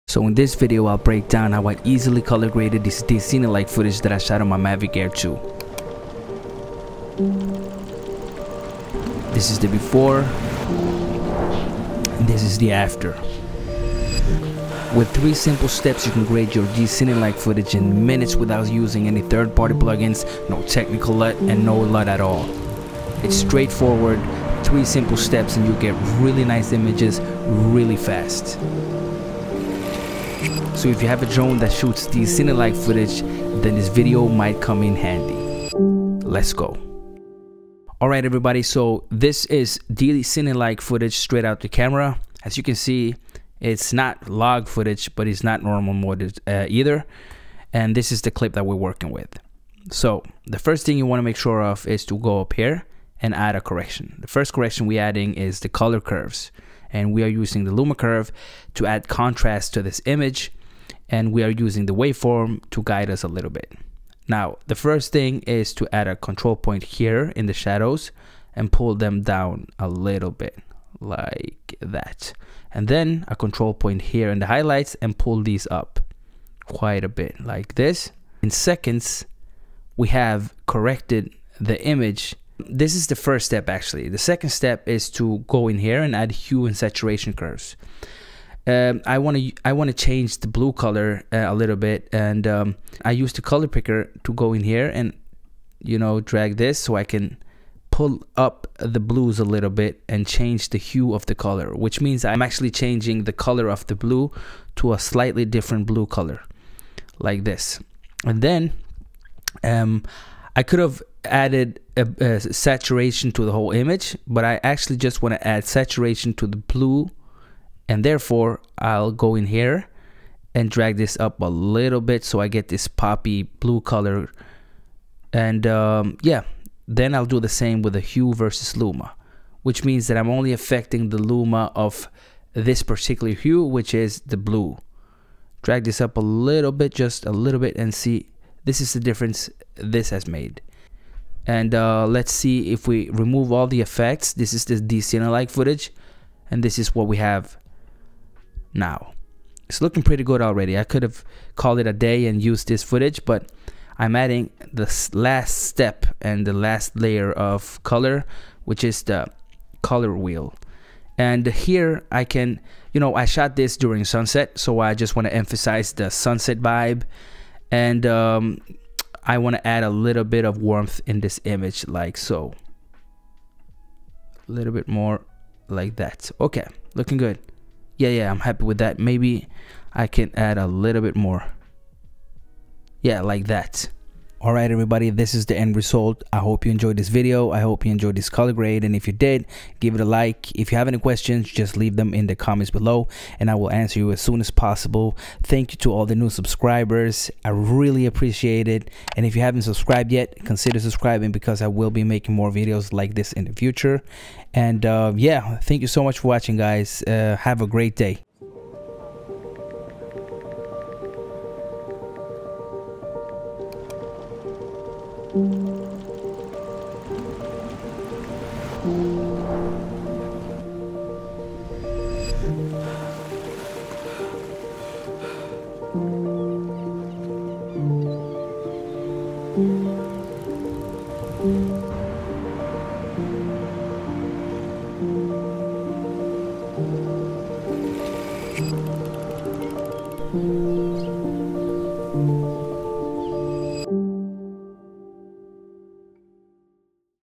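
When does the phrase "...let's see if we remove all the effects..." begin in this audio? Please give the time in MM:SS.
02:22.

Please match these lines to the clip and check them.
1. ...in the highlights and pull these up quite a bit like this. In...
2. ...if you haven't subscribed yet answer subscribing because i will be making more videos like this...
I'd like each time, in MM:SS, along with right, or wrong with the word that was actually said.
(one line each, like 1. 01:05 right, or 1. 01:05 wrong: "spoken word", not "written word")
1. 01:14 right
2. 03:19 wrong: "consider", not "answer".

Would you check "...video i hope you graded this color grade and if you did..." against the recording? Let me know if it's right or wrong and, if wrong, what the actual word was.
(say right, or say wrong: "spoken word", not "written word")
wrong: "enjoyed", not "graded".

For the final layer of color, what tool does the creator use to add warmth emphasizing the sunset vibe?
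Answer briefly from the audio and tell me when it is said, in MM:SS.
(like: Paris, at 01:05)
Color wheel, at 02:39.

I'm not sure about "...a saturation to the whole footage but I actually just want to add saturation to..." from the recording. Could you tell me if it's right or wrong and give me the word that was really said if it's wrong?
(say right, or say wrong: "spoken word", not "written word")
wrong: "image", not "footage".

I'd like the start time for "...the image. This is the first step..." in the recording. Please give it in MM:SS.
01:21.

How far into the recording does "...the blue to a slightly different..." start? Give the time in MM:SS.
01:43.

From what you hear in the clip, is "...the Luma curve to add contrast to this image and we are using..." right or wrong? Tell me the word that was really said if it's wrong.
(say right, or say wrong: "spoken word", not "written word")
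right.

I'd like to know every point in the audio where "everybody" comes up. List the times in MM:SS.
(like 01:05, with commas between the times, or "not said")
00:38, 03:04.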